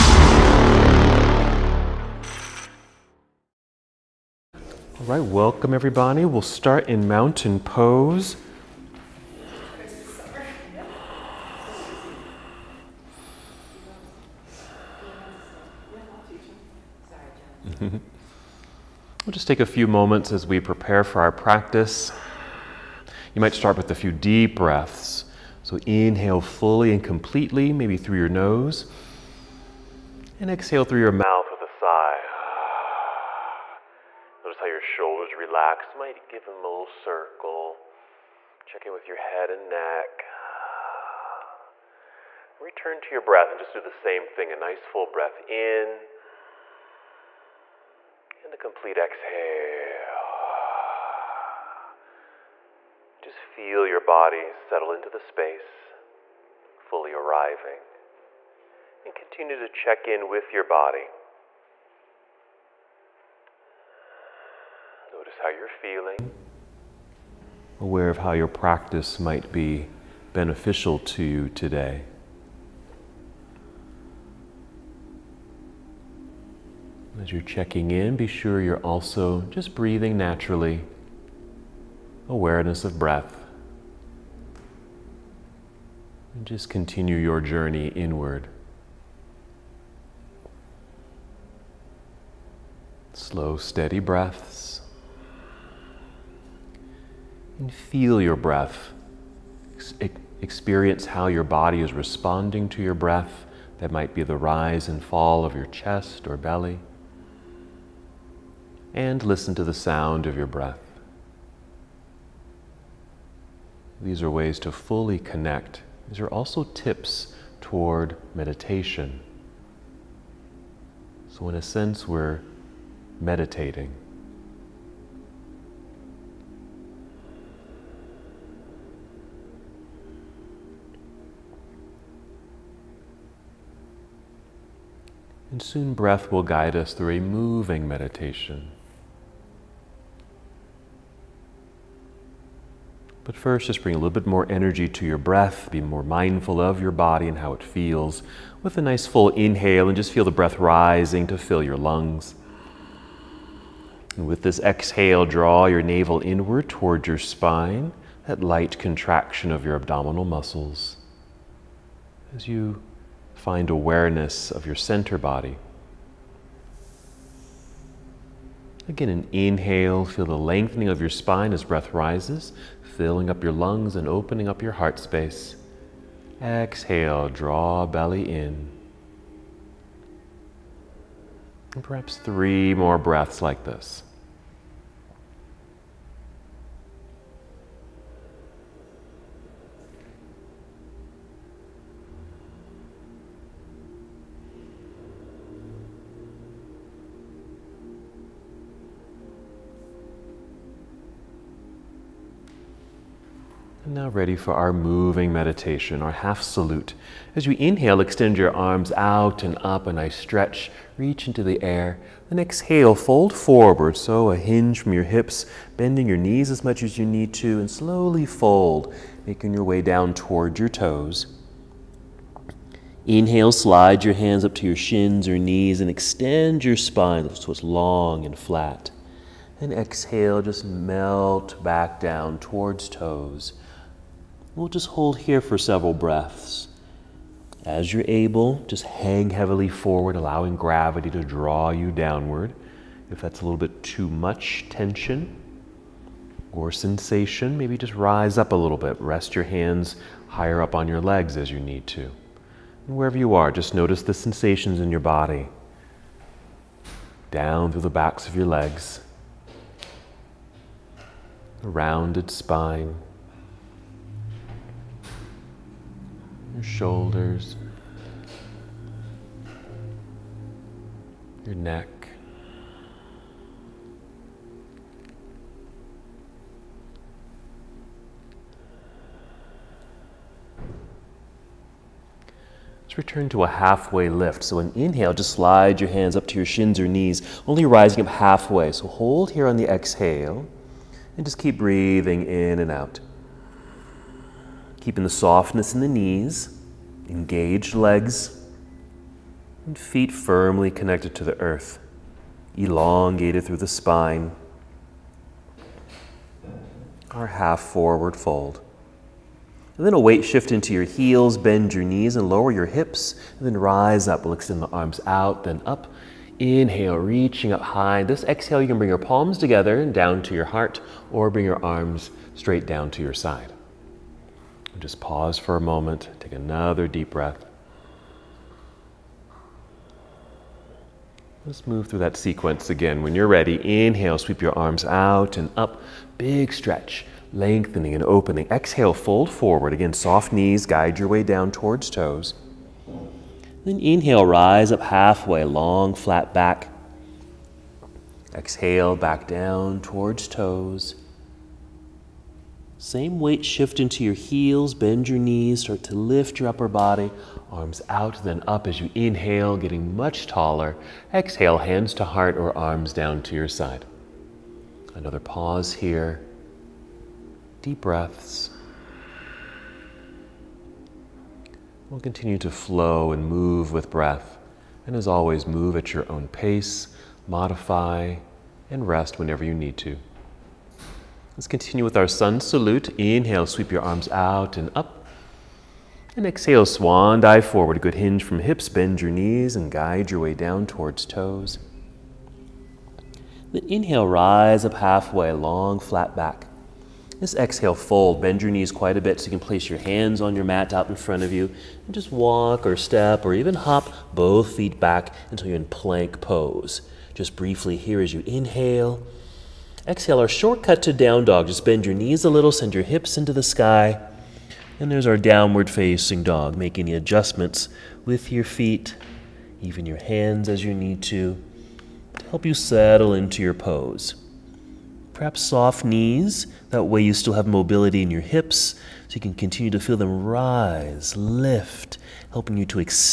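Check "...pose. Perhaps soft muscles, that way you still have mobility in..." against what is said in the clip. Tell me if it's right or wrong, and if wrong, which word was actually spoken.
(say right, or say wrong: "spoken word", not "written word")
wrong: "knees", not "muscles".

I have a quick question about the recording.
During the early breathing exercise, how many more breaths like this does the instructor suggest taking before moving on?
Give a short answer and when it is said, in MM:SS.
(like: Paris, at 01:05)
3, at 03:02.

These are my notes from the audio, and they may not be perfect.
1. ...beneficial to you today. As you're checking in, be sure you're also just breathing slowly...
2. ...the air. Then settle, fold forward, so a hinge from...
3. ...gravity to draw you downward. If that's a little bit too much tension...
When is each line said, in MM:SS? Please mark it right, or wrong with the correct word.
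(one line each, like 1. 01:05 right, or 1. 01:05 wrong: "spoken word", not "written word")
1. 01:10 wrong: "naturally", not "slowly"
2. 03:31 wrong: "exhale", not "settle"
3. 04:00 right.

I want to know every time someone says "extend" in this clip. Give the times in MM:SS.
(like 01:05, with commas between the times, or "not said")
03:28, 03:45, 05:14.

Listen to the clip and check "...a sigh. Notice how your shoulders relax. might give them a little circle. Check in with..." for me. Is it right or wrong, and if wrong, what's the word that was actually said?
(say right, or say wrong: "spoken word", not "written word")
right.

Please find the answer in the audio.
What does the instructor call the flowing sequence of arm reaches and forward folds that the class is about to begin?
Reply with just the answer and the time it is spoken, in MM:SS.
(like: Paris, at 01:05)
Half salute, at 03:26.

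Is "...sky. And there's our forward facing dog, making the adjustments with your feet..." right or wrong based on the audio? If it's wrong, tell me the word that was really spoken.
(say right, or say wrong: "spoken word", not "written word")
wrong: "downward", not "forward".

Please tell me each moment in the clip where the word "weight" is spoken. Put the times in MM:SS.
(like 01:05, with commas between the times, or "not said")
05:09, 05:53.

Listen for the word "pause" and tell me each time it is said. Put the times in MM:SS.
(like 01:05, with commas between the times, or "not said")
05:24, 06:05.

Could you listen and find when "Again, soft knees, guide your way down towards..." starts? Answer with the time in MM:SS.
05:39.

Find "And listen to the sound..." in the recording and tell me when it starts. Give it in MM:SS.
01:48.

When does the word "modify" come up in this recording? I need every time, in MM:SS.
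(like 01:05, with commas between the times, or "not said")
06:17.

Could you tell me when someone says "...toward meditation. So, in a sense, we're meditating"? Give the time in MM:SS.
01:57.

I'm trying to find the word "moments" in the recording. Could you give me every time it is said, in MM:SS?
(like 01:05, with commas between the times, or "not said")
00:19, 05:25.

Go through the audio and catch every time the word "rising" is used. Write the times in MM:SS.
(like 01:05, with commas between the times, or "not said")
02:30, 04:47.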